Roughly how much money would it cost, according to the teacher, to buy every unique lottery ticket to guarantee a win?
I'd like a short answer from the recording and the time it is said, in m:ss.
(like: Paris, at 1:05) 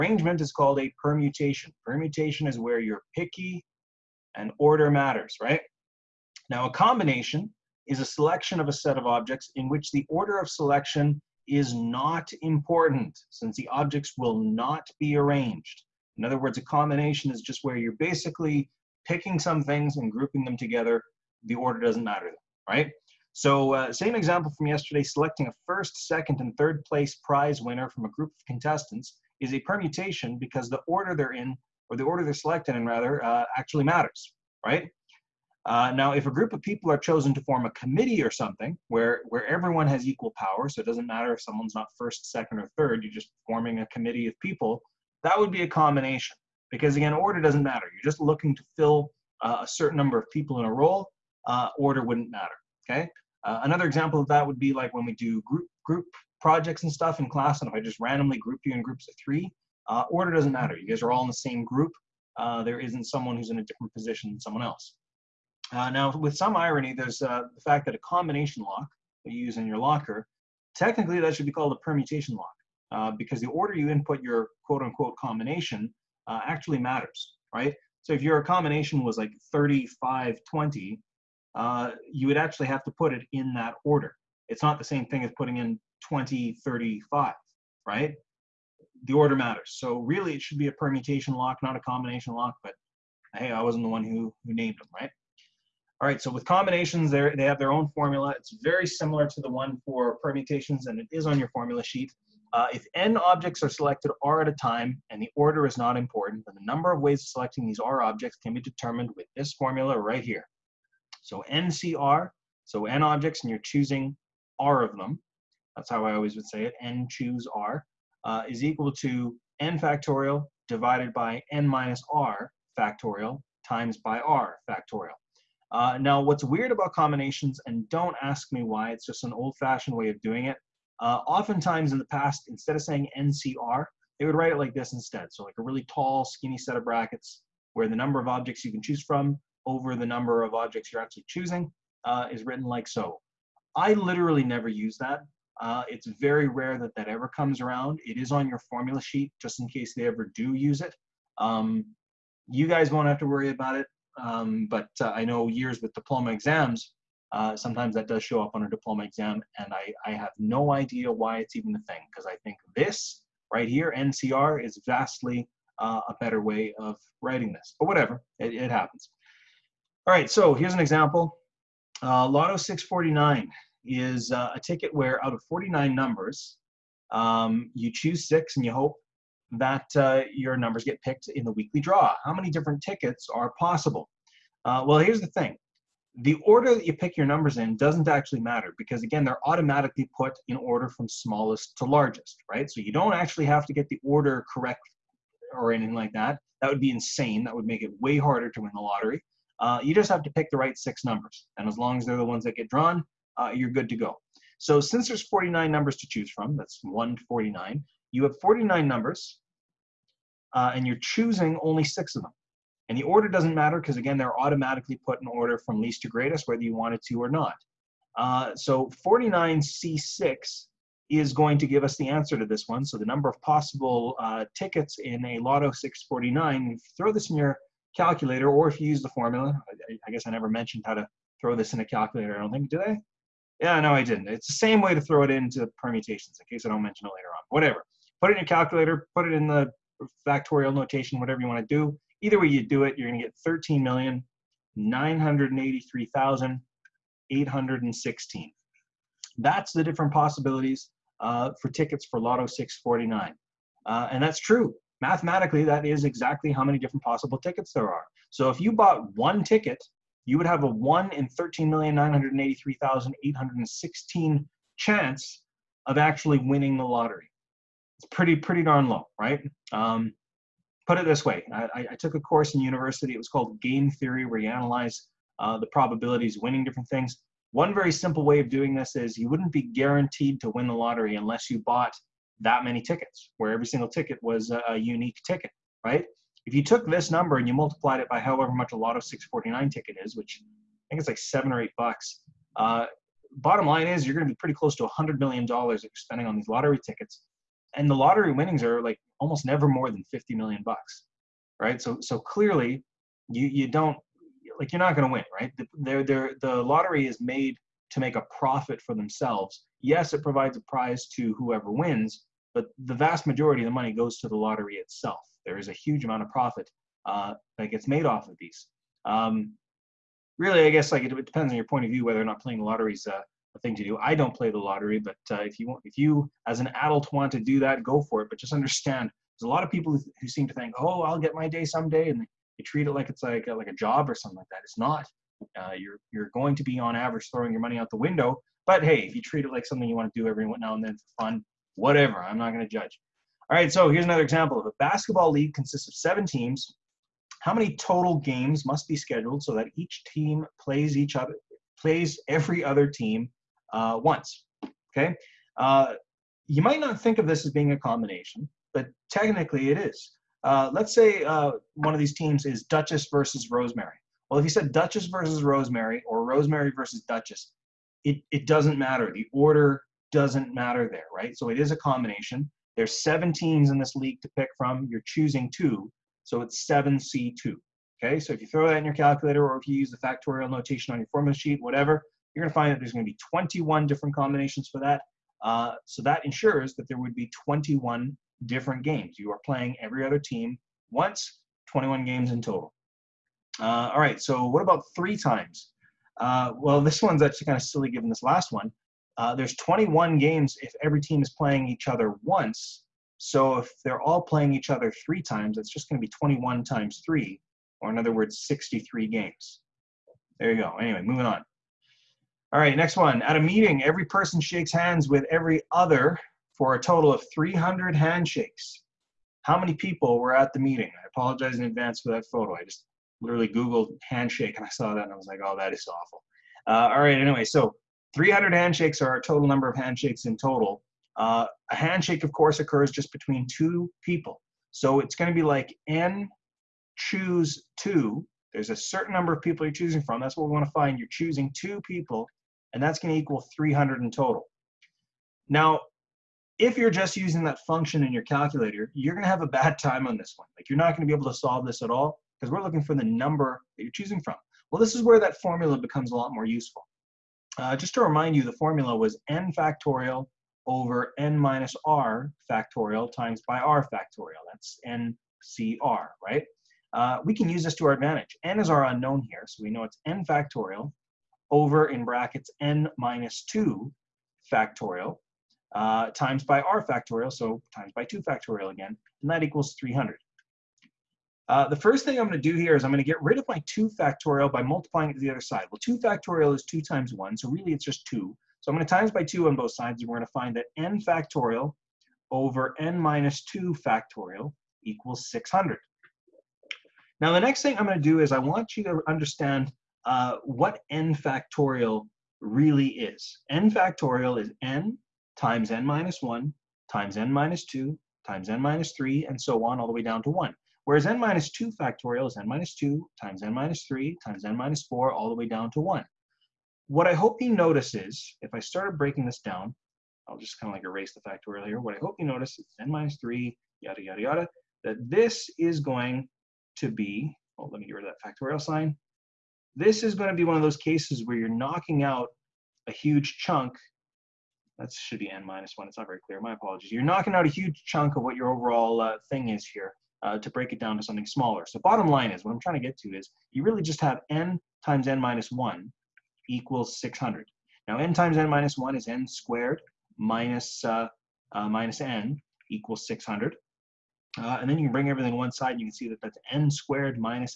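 $100 million, at 4:54.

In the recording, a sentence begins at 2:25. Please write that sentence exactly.
Uh, it's very rare that that ever comes around.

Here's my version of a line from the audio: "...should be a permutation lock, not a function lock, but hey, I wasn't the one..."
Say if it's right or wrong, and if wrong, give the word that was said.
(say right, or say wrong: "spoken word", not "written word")
wrong: "combination", not "function".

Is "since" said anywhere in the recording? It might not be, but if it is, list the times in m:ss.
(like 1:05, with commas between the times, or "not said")
0:13, 3:24.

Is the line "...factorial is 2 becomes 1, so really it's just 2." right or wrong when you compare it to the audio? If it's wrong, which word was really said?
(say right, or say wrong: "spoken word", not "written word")
wrong: "times", not "becomes".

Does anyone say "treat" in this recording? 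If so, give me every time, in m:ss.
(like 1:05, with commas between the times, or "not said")
5:32, 5:39.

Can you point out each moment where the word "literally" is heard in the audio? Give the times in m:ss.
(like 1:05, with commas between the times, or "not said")
2:23, 7:03.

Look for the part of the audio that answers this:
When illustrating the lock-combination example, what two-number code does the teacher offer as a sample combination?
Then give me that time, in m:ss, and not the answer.
1:19.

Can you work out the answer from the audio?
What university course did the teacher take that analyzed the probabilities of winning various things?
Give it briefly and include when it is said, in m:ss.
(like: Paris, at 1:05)
game theory, at 4:33.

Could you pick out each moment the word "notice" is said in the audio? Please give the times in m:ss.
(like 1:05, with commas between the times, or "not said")
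8:37, 8:42.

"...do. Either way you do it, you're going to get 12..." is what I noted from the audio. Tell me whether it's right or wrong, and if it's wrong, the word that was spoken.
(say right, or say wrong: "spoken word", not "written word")
wrong: "13", not "12".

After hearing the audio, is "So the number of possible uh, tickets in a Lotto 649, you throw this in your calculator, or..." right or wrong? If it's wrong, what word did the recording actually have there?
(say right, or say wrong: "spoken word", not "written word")
right.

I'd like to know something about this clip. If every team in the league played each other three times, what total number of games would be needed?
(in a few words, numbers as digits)
63.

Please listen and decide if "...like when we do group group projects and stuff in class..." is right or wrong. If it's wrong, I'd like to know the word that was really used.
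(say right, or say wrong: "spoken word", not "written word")
right.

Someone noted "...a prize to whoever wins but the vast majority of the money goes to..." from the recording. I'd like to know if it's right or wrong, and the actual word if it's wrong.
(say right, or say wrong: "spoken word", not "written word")
right.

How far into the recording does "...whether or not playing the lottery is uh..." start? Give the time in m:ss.
5:22.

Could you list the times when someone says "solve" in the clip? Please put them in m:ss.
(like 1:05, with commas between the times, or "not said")
7:31.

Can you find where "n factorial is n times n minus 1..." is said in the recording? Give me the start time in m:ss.
8:23.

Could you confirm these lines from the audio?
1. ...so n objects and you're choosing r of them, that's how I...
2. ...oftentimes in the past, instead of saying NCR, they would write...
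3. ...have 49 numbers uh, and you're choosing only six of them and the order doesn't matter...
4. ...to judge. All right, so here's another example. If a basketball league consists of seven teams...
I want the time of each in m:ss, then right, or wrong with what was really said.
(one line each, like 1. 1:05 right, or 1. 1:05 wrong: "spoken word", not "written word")
1. 1:52 right
2. 2:11 right
3. 3:28 right
4. 5:42 right.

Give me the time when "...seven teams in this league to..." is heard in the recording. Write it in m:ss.
6:13.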